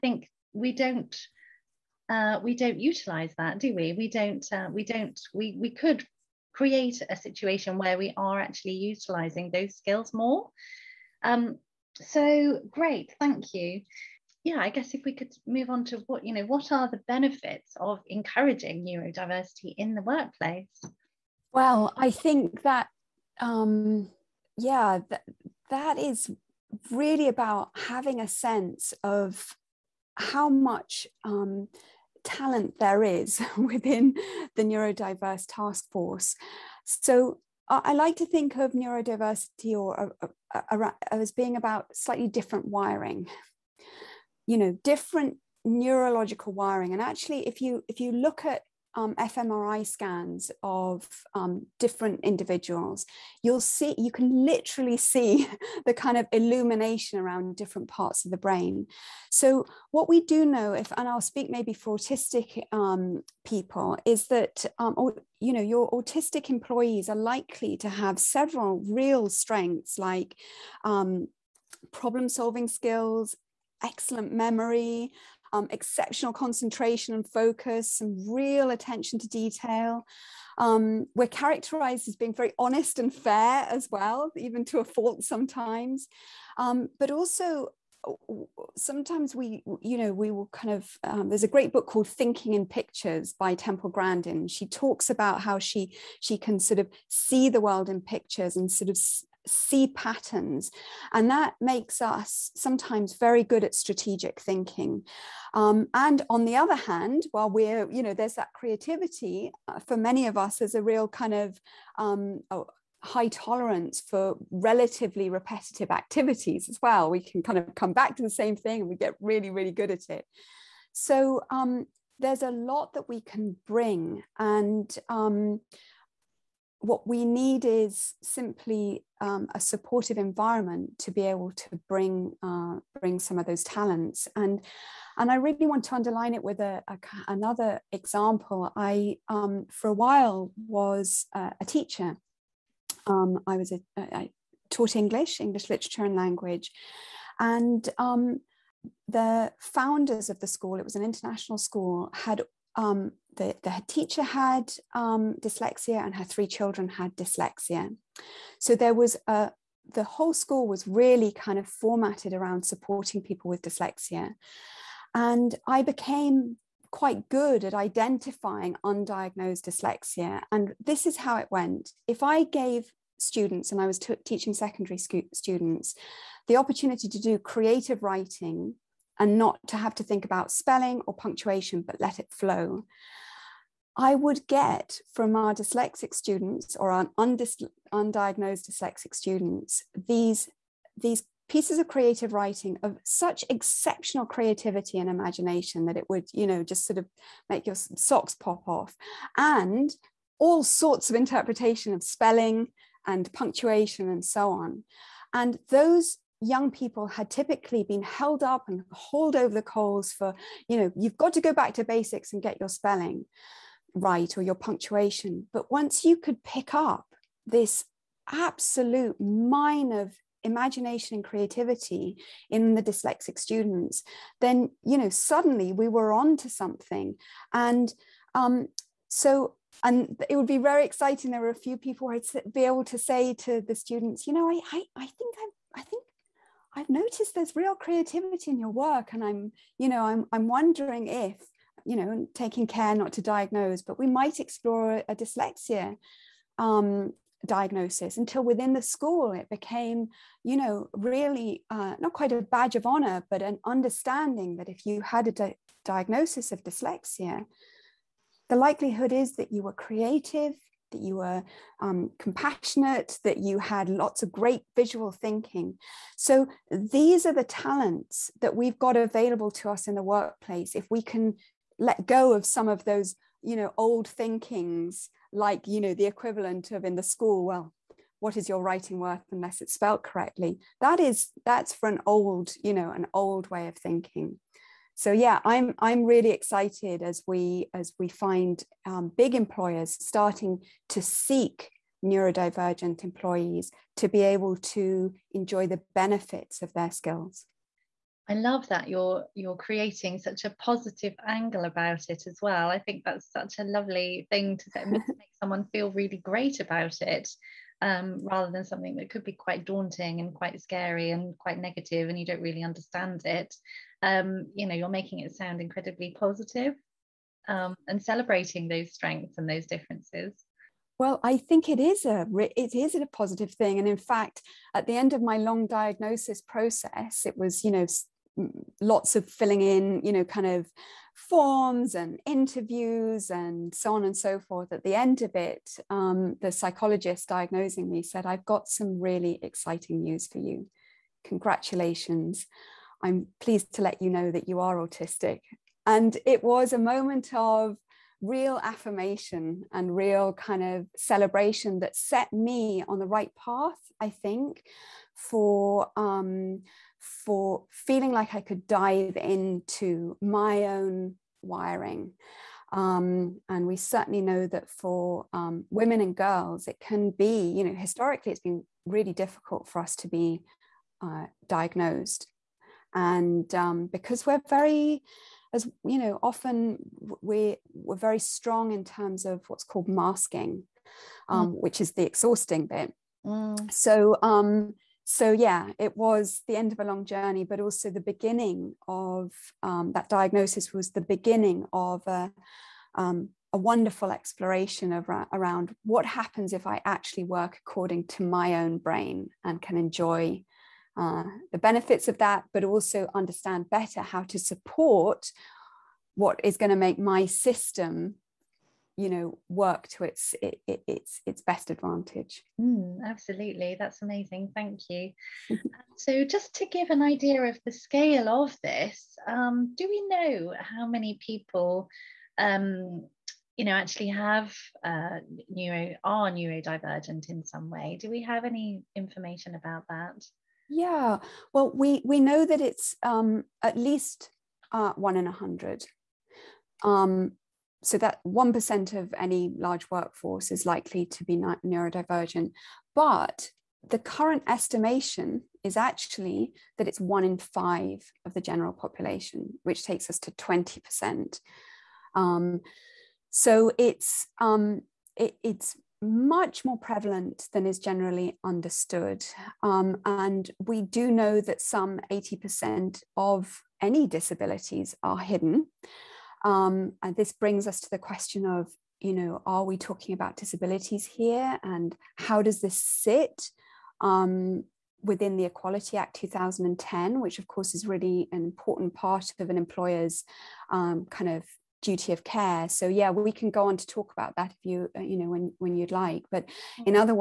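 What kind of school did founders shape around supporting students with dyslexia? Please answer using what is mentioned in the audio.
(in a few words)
International school.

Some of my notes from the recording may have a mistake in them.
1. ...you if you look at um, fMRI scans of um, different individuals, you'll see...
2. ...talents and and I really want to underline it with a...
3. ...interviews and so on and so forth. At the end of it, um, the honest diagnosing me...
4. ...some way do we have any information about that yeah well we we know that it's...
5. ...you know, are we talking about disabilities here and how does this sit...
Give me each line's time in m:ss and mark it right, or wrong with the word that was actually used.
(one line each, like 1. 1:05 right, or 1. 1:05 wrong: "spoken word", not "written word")
1. 0:47 right
2. 2:13 right
3. 5:32 wrong: "psychologist", not "honest"
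4. 7:07 right
5. 7:48 right.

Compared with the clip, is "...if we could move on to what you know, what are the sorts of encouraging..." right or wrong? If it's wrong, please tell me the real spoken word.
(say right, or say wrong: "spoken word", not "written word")
wrong: "benefits", not "sorts".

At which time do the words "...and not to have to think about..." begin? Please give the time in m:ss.
2:59.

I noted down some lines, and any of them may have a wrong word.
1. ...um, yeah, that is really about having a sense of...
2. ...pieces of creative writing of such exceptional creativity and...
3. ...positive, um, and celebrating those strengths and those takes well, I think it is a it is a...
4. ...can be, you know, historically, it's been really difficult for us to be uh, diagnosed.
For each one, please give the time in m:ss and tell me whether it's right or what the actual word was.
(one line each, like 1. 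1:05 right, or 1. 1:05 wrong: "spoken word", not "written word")
1. 0:23 right
2. 3:11 right
3. 5:16 wrong: "differences", not "takes"
4. 6:06 right.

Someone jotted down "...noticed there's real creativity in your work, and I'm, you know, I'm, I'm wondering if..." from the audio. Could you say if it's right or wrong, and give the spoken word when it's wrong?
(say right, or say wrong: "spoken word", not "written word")
right.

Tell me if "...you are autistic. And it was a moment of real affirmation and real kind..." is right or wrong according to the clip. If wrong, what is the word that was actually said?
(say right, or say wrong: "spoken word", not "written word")
right.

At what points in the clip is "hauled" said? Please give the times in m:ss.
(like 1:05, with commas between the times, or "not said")
3:28.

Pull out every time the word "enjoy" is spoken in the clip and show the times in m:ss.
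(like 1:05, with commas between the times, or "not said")
4:55, 6:39.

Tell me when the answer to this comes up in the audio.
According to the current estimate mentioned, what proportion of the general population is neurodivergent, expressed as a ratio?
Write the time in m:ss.
7:26.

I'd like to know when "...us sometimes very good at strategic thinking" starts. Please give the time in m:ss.
1:42.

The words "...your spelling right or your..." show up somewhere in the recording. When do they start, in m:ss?
3:32.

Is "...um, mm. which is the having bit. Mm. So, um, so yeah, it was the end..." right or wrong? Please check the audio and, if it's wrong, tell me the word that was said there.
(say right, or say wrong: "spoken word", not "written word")
wrong: "exhausting", not "having".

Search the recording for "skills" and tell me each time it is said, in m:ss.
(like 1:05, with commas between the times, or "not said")
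0:09, 1:12, 4:56.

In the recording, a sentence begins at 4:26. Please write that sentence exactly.
So these are the talents that we've got available to us in the workplace.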